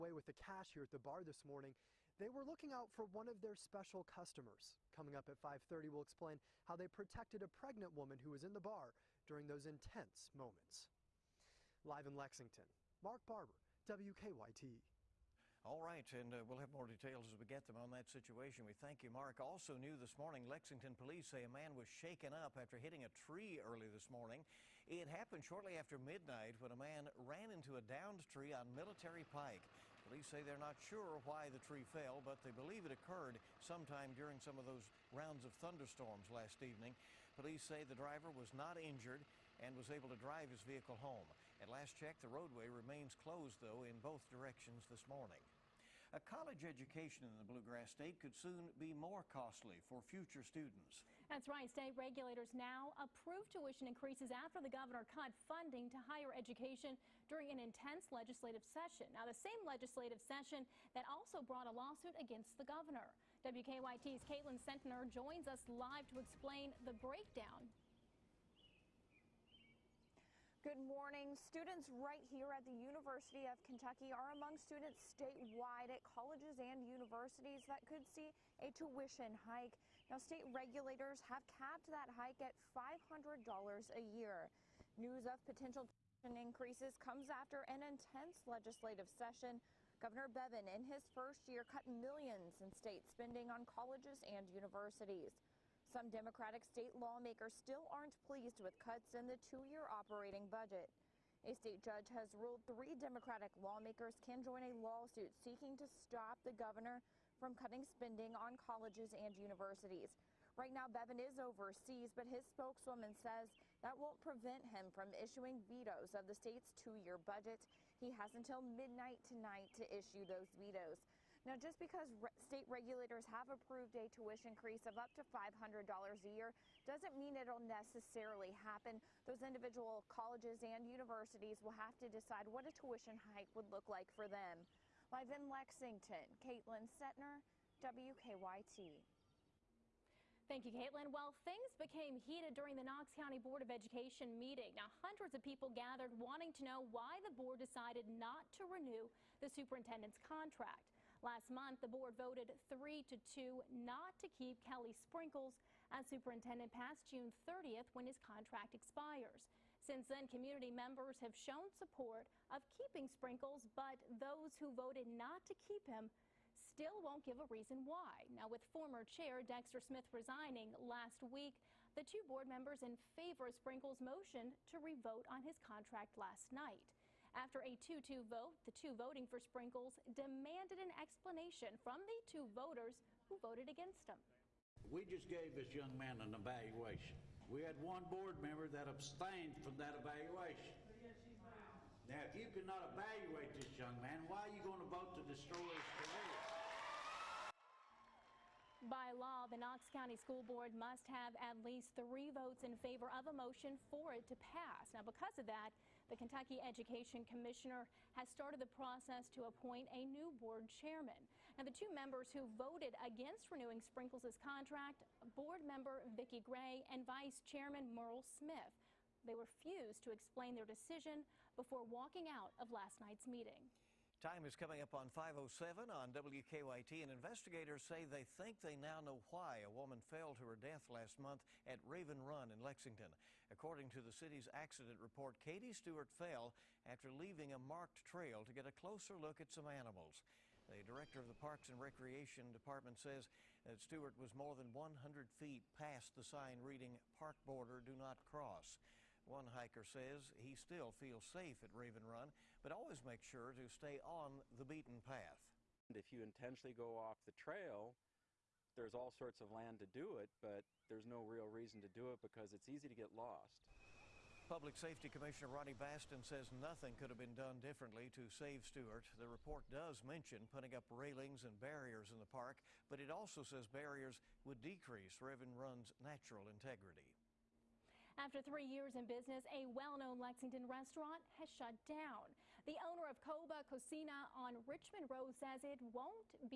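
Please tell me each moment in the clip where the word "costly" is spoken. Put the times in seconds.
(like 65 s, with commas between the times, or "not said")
49 s.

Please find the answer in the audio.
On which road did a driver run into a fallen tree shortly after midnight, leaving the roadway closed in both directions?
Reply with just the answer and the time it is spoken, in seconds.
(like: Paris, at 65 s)
Military Pike, at 28 s.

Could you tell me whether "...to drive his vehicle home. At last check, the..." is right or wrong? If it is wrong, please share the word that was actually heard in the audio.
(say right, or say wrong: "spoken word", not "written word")
right.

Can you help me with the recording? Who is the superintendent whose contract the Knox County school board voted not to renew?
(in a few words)
Kelly Sprinkles.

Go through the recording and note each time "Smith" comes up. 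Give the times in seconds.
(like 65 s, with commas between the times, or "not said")
169 s, 218 s.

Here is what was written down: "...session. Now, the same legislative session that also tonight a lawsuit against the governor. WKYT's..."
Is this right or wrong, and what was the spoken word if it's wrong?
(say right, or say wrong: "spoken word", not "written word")
wrong: "brought", not "tonight".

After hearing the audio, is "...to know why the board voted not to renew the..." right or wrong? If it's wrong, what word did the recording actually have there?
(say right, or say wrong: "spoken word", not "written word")
wrong: "decided", not "voted".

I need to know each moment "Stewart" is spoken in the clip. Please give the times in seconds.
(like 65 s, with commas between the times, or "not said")
235 s, 243 s, 268 s.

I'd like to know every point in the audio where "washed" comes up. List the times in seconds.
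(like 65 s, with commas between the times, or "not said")
not said.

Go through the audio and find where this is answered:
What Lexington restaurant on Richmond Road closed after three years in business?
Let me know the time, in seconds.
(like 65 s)
283 s.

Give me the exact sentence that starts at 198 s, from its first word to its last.
By law, the Knox County School Board must have at least three votes in favor of a motion for it to pass.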